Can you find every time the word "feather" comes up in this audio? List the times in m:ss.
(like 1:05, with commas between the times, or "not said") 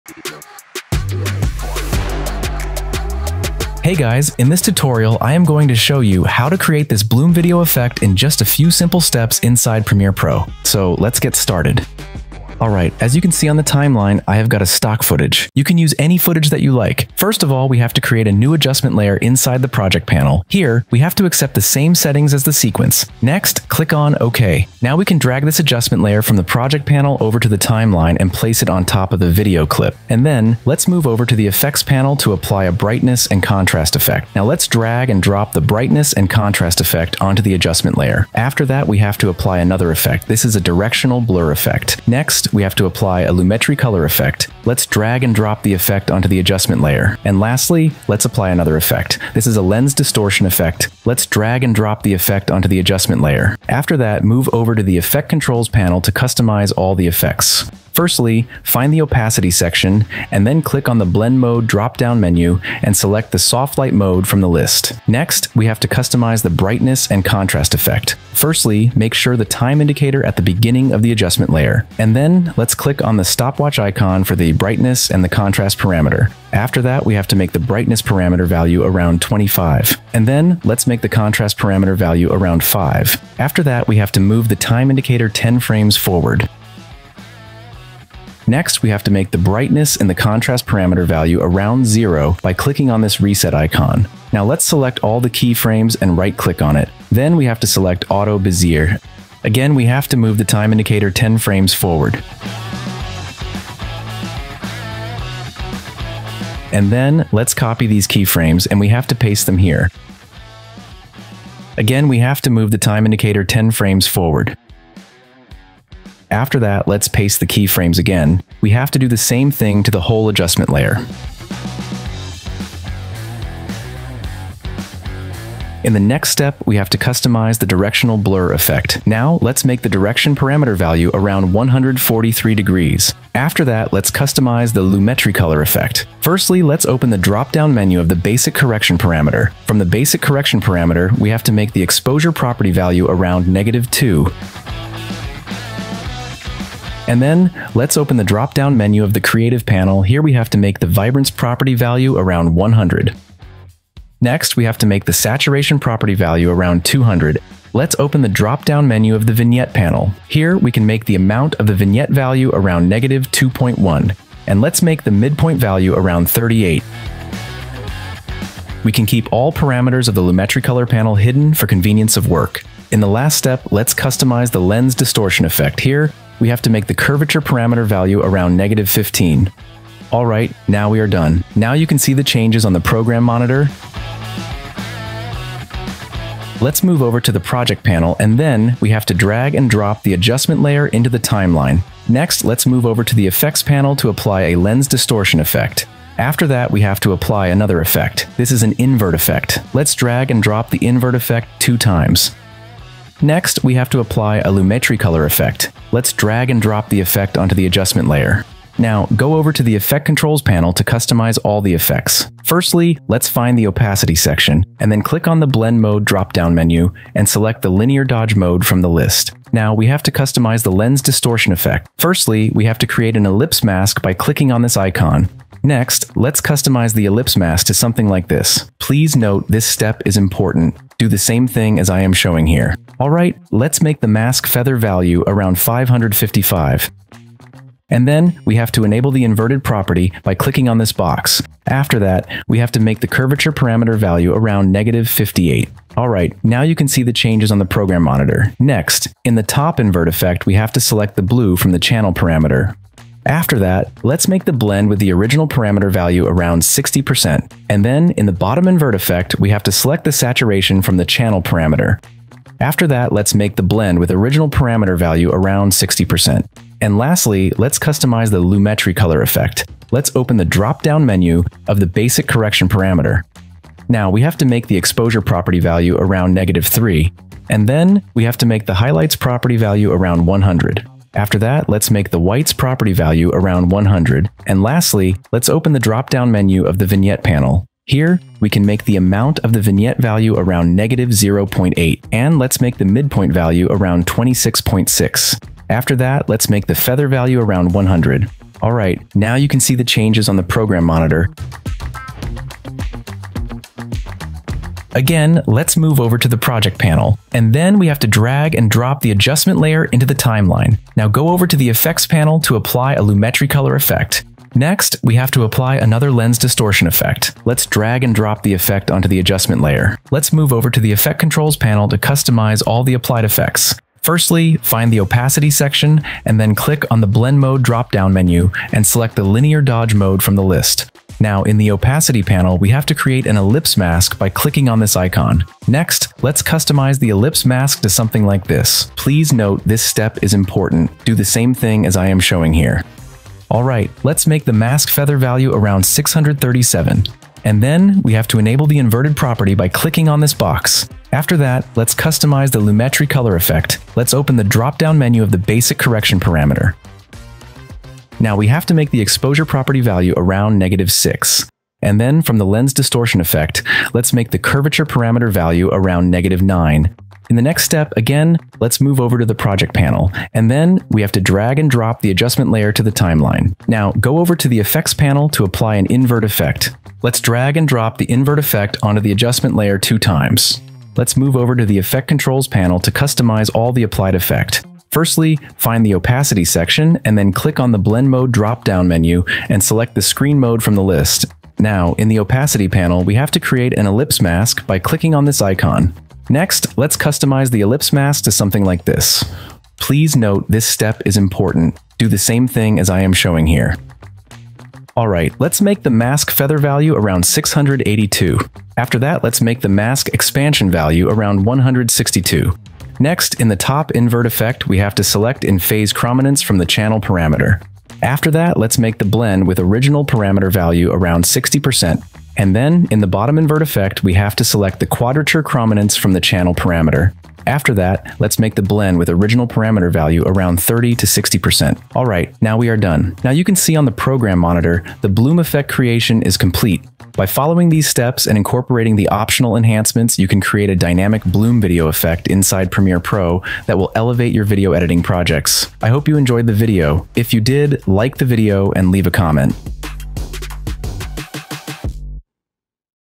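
3:54, 4:56, 5:44, 6:46.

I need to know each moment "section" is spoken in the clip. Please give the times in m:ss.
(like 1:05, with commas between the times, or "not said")
0:59, 3:34, 5:25, 6:26.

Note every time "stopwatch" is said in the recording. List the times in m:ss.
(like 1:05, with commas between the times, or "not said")
1:13.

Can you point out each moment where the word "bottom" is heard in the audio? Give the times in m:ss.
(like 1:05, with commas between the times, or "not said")
4:18, 7:03.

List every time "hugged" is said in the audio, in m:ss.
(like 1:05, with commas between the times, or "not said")
not said.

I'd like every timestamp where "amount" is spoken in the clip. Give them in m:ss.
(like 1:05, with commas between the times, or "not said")
2:41, 4:48.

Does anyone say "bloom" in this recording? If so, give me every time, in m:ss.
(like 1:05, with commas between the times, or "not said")
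0:07, 7:15, 7:21.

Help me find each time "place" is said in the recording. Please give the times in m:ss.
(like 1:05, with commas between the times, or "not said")
0:28.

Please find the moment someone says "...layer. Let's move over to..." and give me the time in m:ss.
5:19.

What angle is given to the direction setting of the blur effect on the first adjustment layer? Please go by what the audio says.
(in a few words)
143 degrees.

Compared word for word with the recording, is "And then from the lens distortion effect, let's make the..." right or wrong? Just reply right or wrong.
right.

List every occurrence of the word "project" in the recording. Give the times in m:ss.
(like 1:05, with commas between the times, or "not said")
0:19, 0:26, 3:07, 5:06, 6:09, 7:25.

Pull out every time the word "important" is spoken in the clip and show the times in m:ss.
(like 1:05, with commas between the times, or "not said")
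3:50, 5:40, 6:41.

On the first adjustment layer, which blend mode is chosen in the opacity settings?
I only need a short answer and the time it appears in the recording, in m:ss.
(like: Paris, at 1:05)
Soft Light, at 1:03.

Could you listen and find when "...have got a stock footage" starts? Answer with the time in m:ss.
0:14.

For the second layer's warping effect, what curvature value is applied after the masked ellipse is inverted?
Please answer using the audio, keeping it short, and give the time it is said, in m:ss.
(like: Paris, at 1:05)
-58, at 4:04.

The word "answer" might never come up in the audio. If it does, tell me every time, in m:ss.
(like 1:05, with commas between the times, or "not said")
not said.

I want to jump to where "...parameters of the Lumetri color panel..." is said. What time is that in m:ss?
2:49.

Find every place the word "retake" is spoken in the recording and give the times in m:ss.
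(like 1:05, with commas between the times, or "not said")
not said.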